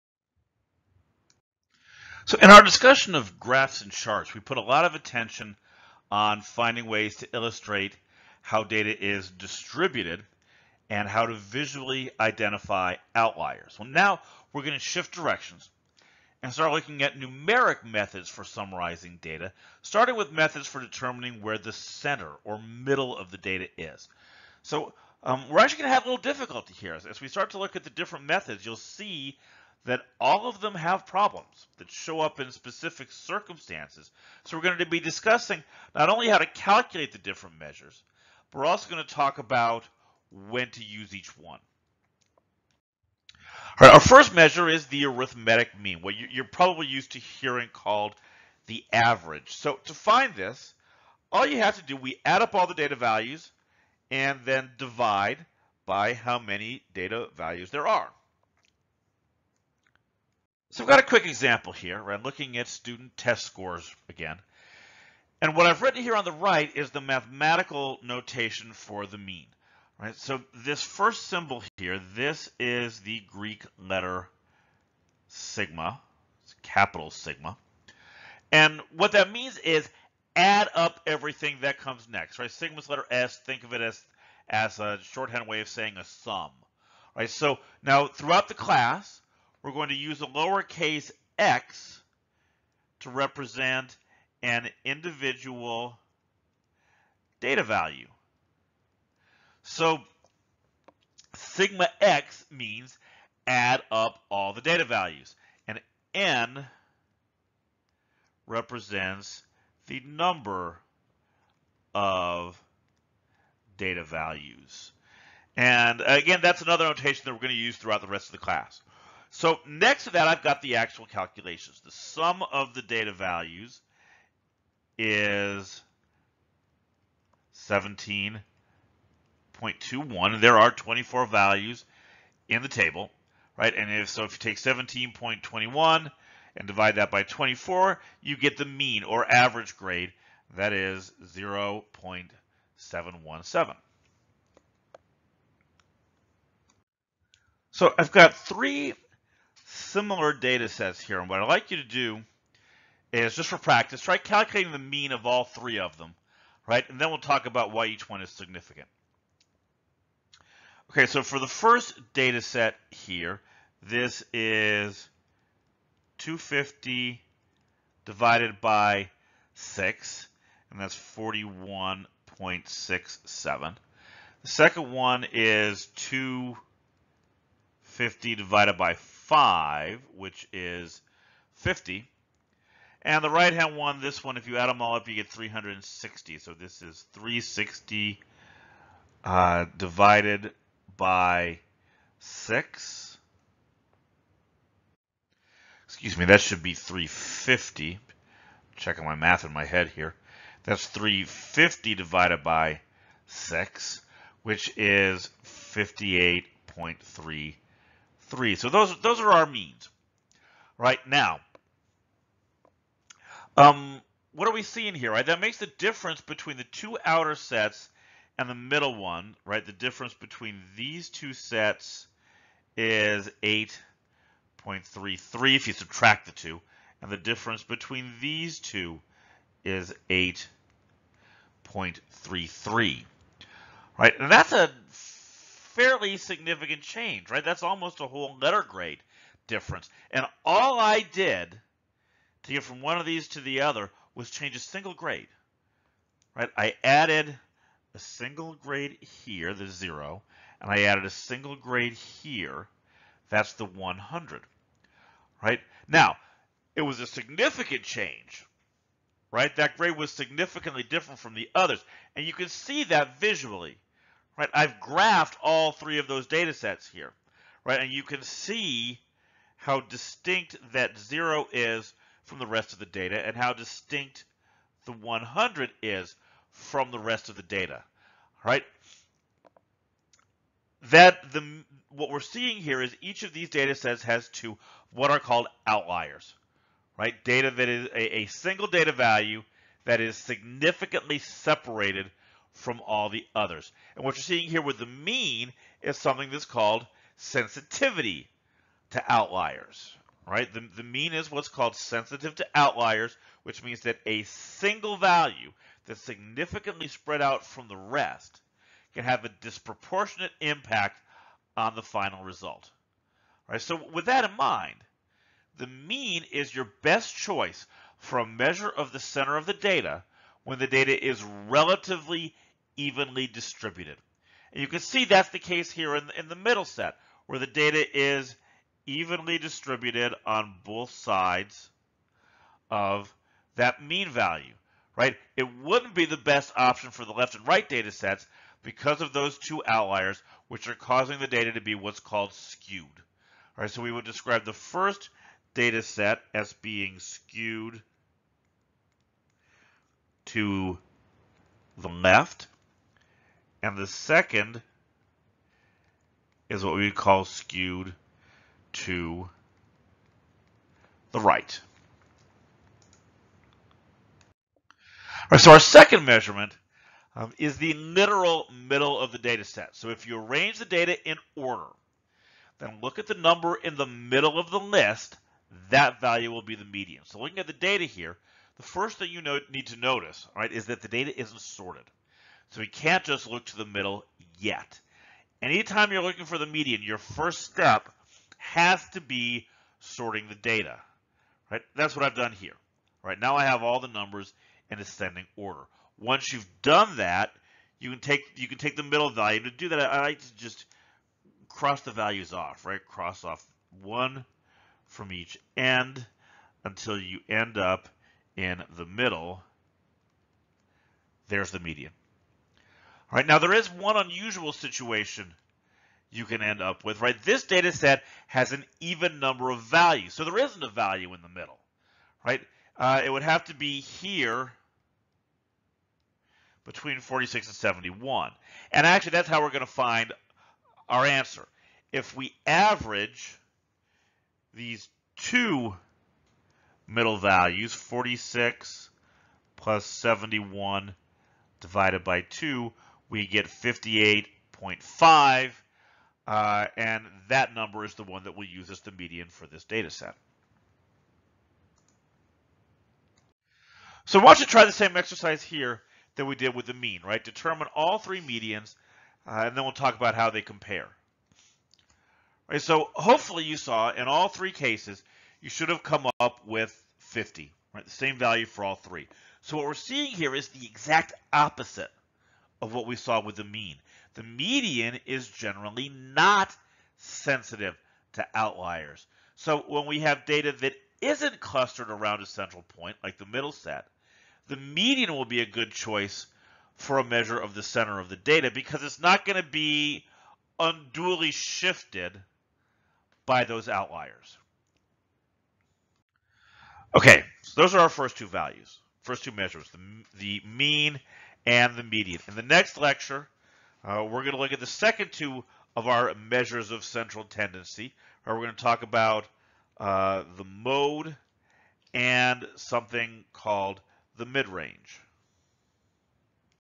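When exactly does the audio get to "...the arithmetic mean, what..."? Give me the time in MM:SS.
00:44.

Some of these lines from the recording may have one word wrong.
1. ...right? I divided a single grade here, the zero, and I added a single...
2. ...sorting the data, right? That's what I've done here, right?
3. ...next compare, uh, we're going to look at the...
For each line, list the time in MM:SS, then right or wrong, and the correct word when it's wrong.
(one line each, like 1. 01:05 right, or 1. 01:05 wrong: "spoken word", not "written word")
1. 04:06 wrong: "added", not "divided"
2. 06:29 right
3. 08:22 wrong: "lecture", not "compare".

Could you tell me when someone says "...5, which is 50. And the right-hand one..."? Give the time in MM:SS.
02:59.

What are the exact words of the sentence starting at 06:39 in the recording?
To do that, I like to just cross the values off, right?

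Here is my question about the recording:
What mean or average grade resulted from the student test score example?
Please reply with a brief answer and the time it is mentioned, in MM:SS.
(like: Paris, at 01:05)
0.717, at 02:21.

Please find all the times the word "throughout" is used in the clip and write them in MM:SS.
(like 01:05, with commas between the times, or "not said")
01:28, 01:57.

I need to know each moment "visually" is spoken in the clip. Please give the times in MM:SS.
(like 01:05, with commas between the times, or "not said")
00:11, 04:23.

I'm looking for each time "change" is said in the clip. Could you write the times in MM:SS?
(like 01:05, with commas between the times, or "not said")
03:56, 04:04, 04:17.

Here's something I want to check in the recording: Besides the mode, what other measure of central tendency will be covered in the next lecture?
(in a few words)
midrange.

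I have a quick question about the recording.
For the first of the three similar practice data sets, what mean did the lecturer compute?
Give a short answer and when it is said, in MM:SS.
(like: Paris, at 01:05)
41.67, at 02:51.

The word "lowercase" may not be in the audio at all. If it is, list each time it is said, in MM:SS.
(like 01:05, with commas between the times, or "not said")
01:30.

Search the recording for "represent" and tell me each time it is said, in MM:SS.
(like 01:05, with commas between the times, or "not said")
01:33, 01:48.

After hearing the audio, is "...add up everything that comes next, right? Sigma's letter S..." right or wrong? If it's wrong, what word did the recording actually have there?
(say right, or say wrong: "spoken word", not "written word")
right.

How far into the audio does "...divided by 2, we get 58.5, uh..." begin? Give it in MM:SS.
07:21.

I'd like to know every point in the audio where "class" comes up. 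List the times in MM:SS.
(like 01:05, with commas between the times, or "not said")
01:28, 01:58.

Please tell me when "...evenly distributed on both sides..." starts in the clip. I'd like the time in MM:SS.
05:28.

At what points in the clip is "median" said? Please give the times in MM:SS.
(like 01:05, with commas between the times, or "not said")
06:16, 06:26, 06:51, 07:28, 07:38, 07:54, 08:04, 08:21.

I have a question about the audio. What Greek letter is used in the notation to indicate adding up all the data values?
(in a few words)
capital sigma.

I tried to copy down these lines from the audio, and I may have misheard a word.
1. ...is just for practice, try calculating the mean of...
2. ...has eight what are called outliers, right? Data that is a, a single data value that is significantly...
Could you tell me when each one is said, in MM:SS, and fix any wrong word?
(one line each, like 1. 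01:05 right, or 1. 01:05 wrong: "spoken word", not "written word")
1. 02:33 right
2. 04:44 wrong: "two", not "eight".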